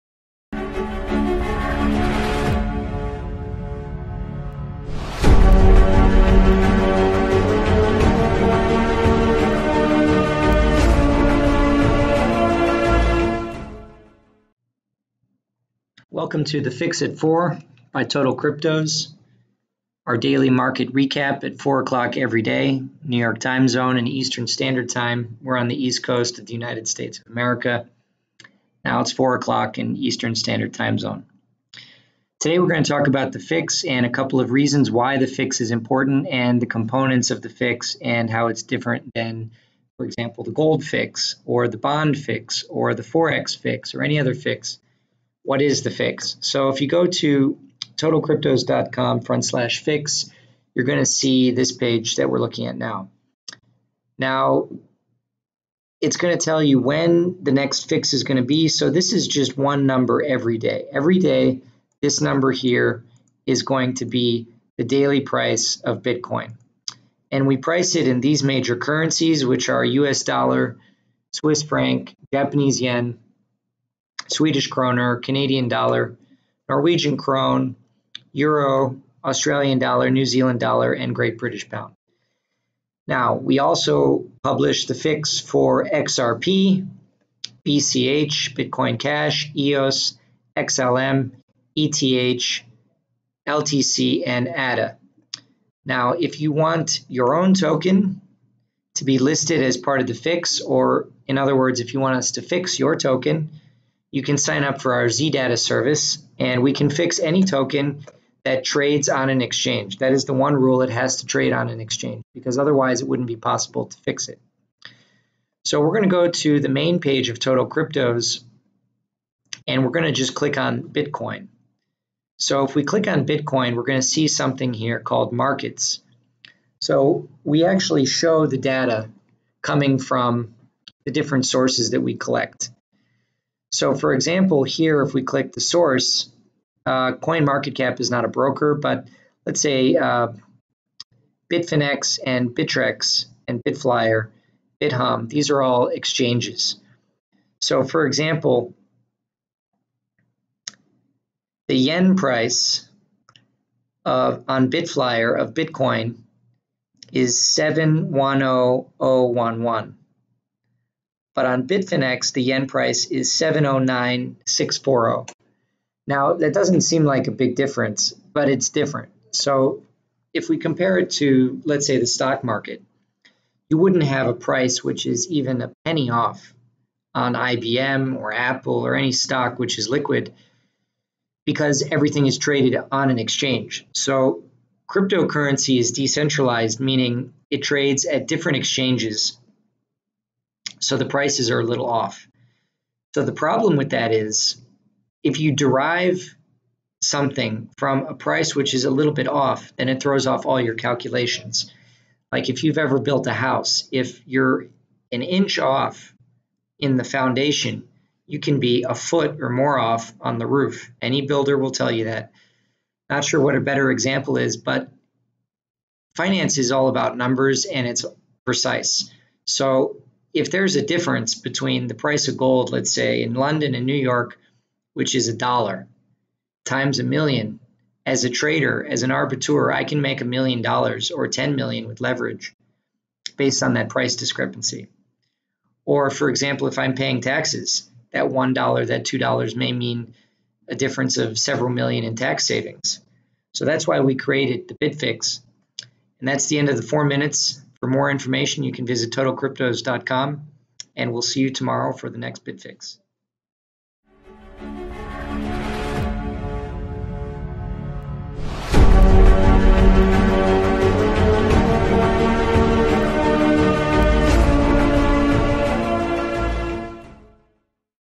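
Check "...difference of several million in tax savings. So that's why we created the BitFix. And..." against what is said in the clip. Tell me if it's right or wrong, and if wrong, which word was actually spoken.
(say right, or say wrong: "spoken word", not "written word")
right.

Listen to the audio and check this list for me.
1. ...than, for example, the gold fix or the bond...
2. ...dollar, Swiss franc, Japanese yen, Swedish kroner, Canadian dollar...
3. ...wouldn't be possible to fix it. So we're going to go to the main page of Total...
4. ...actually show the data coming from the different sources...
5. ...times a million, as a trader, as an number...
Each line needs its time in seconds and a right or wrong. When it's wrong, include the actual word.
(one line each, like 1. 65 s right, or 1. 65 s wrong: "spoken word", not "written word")
1. 39 s right
2. 70 s right
3. 113 s right
4. 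127 s right
5. 226 s wrong: "arbiter", not "number".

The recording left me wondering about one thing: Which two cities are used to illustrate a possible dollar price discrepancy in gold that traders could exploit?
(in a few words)
London and New York.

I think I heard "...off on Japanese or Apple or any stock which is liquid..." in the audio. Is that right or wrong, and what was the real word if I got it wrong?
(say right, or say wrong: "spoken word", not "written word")
wrong: "IBM", not "Japanese".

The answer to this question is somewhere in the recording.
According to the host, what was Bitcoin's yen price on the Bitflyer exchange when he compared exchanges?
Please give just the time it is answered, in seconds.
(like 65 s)
157 s.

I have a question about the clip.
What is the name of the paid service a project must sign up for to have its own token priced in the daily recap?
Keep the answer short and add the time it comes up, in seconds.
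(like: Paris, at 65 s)
ZData, at 105 s.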